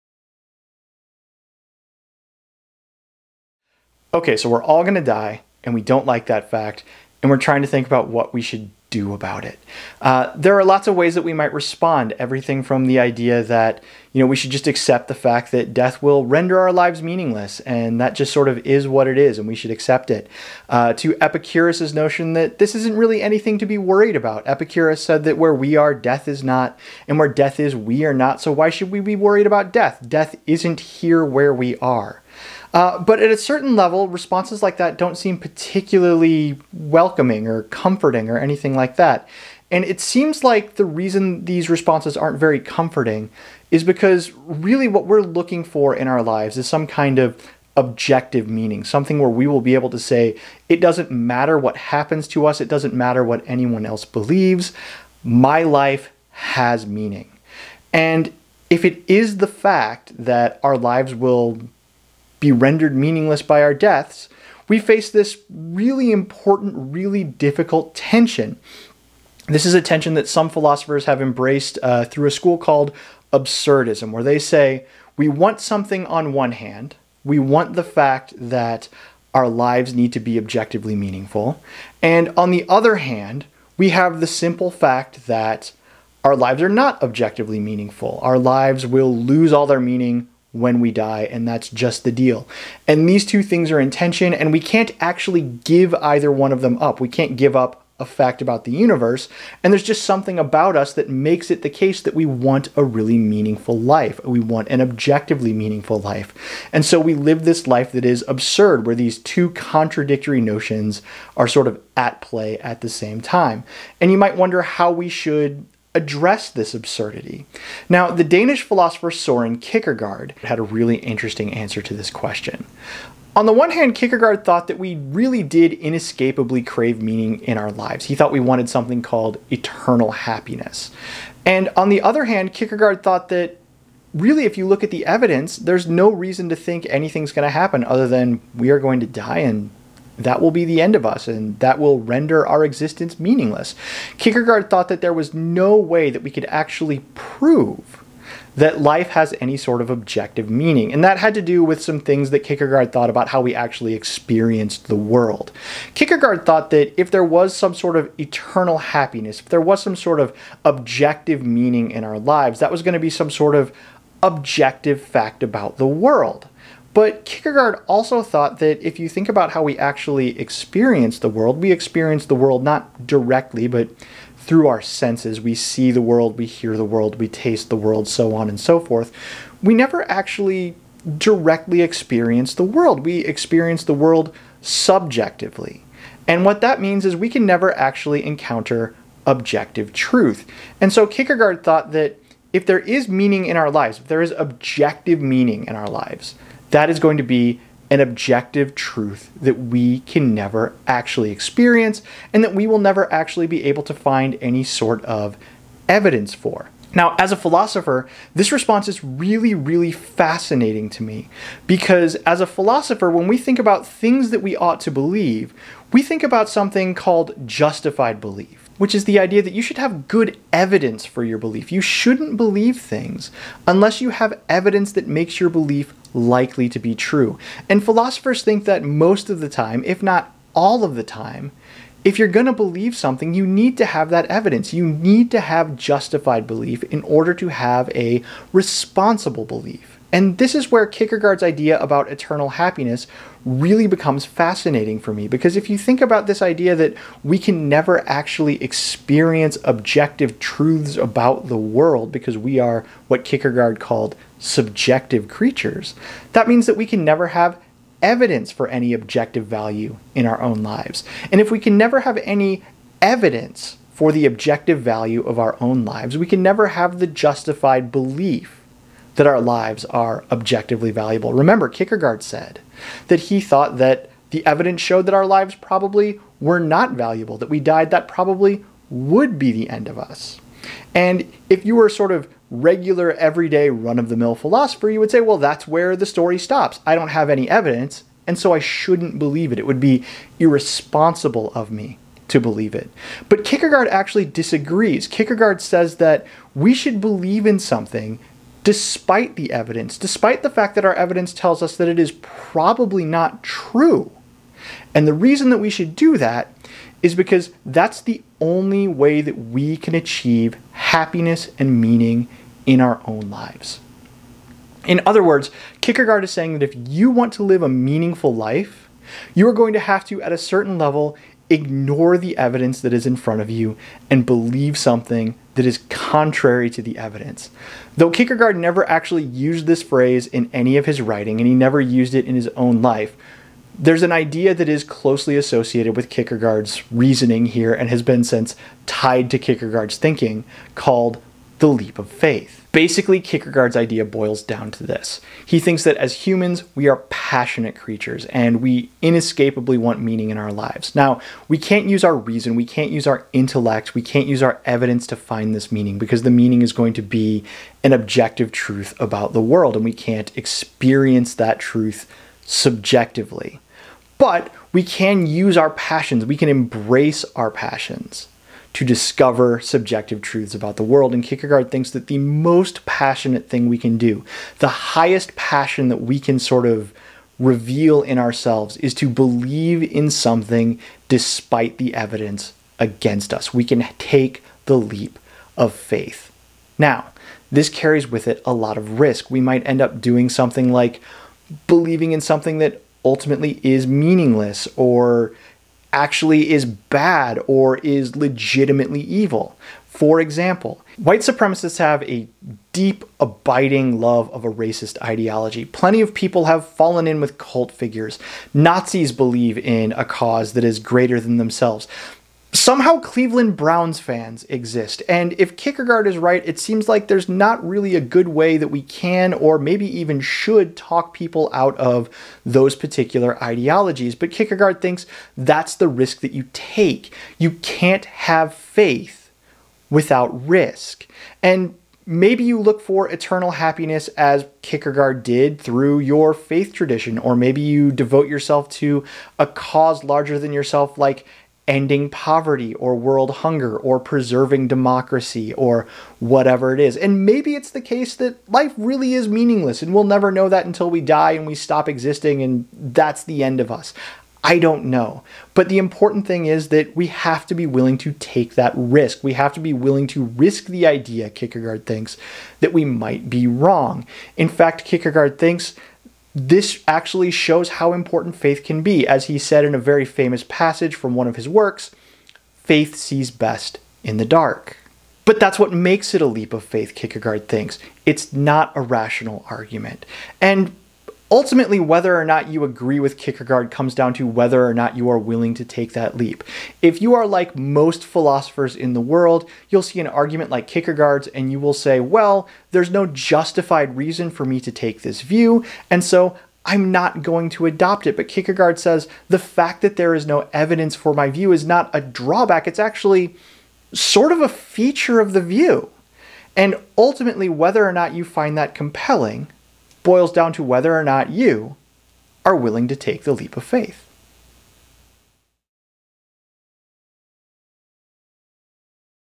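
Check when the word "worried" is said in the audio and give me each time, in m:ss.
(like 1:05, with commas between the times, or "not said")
0:23, 0:29.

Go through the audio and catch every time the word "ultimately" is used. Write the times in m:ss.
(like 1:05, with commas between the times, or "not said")
6:33, 8:01, 8:26.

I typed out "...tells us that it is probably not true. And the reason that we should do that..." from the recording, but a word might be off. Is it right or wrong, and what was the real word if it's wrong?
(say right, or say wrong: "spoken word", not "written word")
right.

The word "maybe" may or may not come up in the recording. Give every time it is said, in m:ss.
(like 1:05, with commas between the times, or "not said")
6:59, 7:12, 7:17, 7:27.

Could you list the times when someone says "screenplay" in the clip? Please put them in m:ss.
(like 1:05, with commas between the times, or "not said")
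not said.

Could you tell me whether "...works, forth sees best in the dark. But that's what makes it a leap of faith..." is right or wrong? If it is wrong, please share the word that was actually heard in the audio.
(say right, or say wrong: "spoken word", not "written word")
wrong: "faith", not "forth".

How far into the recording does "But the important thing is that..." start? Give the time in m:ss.
7:35.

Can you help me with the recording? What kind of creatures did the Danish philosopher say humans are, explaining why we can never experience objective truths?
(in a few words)
subjective creatures.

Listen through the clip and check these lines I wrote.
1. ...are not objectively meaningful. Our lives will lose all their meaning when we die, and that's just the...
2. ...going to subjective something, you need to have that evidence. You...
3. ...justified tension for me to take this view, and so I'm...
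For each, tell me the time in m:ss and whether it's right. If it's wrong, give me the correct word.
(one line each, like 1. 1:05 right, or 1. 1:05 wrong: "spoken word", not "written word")
1. 1:26 right
2. 3:52 wrong: "believe", not "subjective"
3. 8:13 wrong: "reason", not "tension".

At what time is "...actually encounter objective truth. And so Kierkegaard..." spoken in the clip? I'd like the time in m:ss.
3:07.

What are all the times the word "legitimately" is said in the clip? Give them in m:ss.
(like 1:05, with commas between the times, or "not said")
6:38.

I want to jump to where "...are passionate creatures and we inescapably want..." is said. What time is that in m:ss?
5:46.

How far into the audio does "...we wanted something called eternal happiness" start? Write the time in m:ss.
2:08.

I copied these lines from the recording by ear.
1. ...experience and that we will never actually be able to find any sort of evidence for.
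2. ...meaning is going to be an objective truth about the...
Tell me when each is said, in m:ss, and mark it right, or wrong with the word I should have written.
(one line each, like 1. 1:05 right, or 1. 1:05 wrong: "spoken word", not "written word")
1. 3:21 right
2. 5:56 right.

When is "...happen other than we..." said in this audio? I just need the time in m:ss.
2:17.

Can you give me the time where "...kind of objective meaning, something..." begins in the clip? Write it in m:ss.
0:46.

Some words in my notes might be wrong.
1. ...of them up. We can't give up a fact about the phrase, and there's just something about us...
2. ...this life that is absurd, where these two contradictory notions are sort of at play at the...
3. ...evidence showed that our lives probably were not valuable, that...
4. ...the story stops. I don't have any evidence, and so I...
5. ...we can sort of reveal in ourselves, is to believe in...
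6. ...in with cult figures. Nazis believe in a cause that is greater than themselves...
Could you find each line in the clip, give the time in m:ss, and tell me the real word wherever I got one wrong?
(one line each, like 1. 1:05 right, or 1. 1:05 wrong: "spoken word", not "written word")
1. 1:36 wrong: "universe", not "phrase"
2. 1:47 right
3. 4:34 right
4. 4:45 right
5. 6:16 right
6. 6:47 right.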